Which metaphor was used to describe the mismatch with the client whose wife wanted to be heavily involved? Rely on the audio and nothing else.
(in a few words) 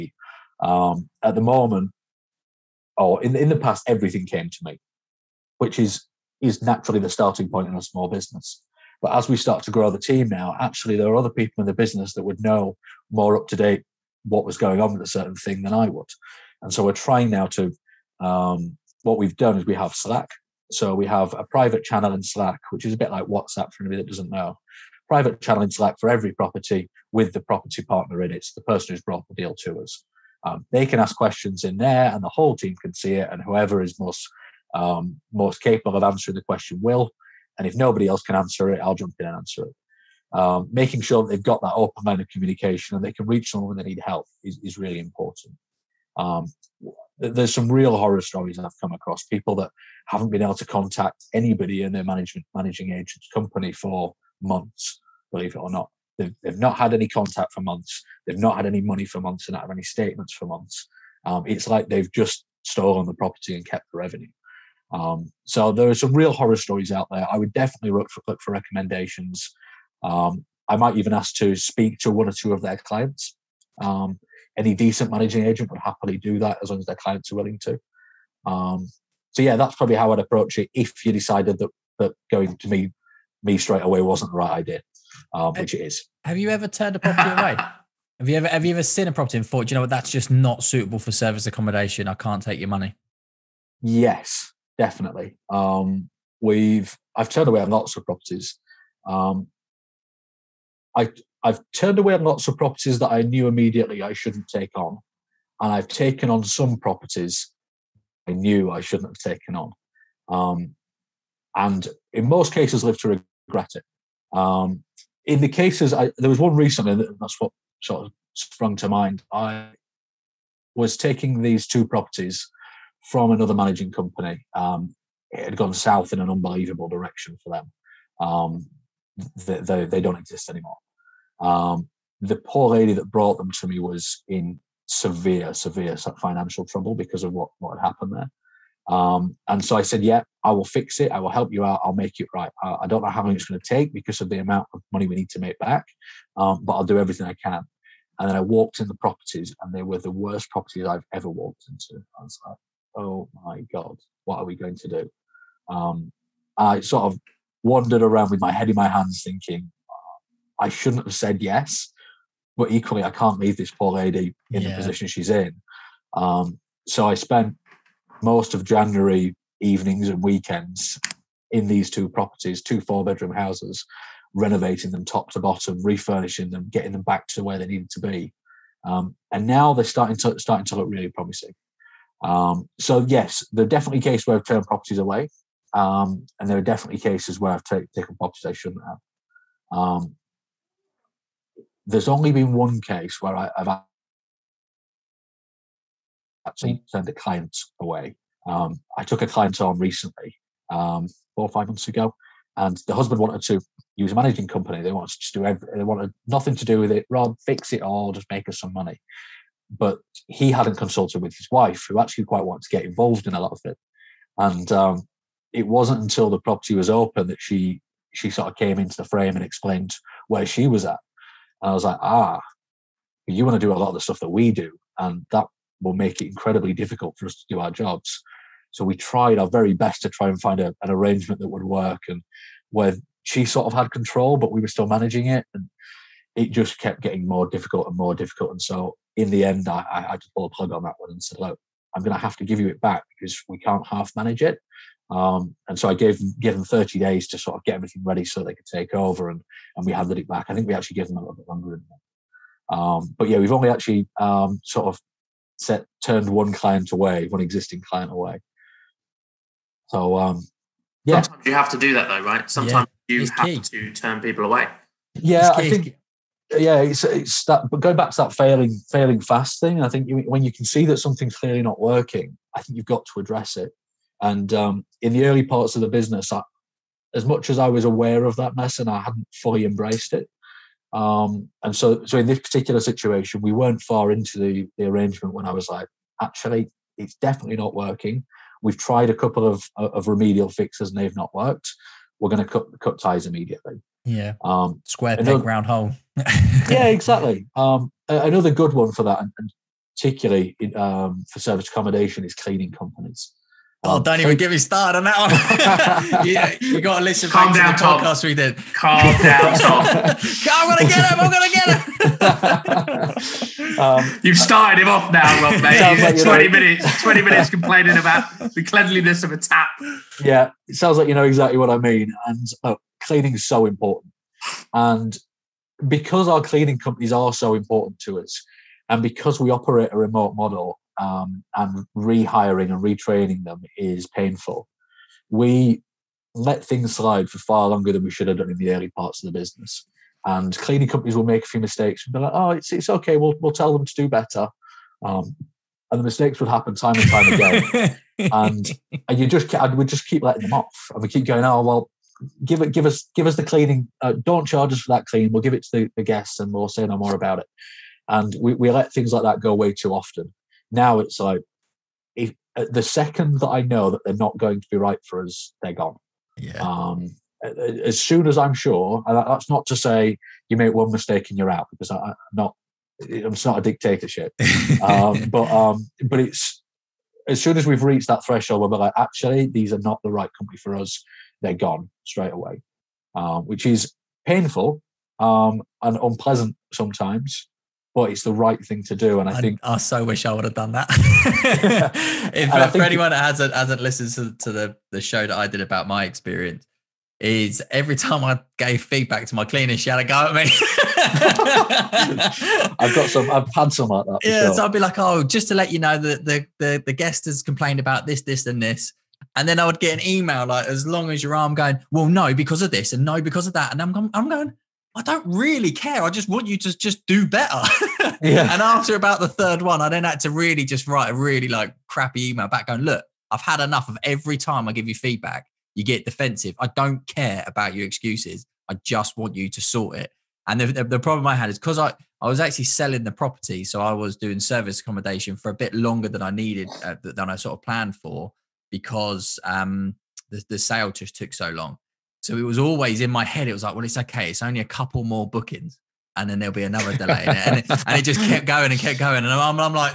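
Square peg, round hole.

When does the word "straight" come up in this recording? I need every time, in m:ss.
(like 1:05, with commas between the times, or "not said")
1:23, 6:22.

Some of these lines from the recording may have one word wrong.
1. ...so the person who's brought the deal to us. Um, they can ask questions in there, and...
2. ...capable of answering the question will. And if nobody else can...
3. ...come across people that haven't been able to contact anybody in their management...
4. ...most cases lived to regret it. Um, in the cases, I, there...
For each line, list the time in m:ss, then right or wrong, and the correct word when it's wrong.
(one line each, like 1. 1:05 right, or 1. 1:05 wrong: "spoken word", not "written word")
1. 0:28 right
2. 0:35 right
3. 0:48 right
4. 1:52 right.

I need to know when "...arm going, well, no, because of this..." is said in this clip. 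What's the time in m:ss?
6:51.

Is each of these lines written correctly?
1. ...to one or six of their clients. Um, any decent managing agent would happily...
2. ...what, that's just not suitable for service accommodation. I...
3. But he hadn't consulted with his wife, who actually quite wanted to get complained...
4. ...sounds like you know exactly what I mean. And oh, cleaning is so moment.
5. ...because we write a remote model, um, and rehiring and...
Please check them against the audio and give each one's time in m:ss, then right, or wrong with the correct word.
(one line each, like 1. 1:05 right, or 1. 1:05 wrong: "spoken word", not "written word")
1. 1:11 wrong: "two", not "six"
2. 1:29 right
3. 3:29 wrong: "involved", not "complained"
4. 5:20 wrong: "important", not "moment"
5. 5:29 wrong: "operate", not "write".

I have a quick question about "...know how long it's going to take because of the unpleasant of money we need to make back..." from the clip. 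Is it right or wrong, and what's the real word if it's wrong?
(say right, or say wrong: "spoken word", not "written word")
wrong: "amount", not "unpleasant".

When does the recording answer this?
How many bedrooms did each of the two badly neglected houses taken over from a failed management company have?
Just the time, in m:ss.
2:52.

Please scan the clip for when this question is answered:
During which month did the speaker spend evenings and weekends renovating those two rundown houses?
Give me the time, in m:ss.
2:48.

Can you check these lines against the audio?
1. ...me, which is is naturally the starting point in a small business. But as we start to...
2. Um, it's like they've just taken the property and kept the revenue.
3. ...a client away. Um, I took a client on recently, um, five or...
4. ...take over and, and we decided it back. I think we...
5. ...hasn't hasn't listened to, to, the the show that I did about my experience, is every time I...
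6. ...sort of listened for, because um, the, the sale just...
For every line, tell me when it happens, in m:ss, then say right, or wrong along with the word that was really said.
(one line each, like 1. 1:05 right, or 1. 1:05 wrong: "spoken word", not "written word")
1. 0:04 right
2. 1:01 wrong: "stolen", not "taken"
3. 3:17 wrong: "four", not "five"
4. 4:08 wrong: "handed", not "decided"
5. 6:33 right
6. 7:17 wrong: "planned", not "listened".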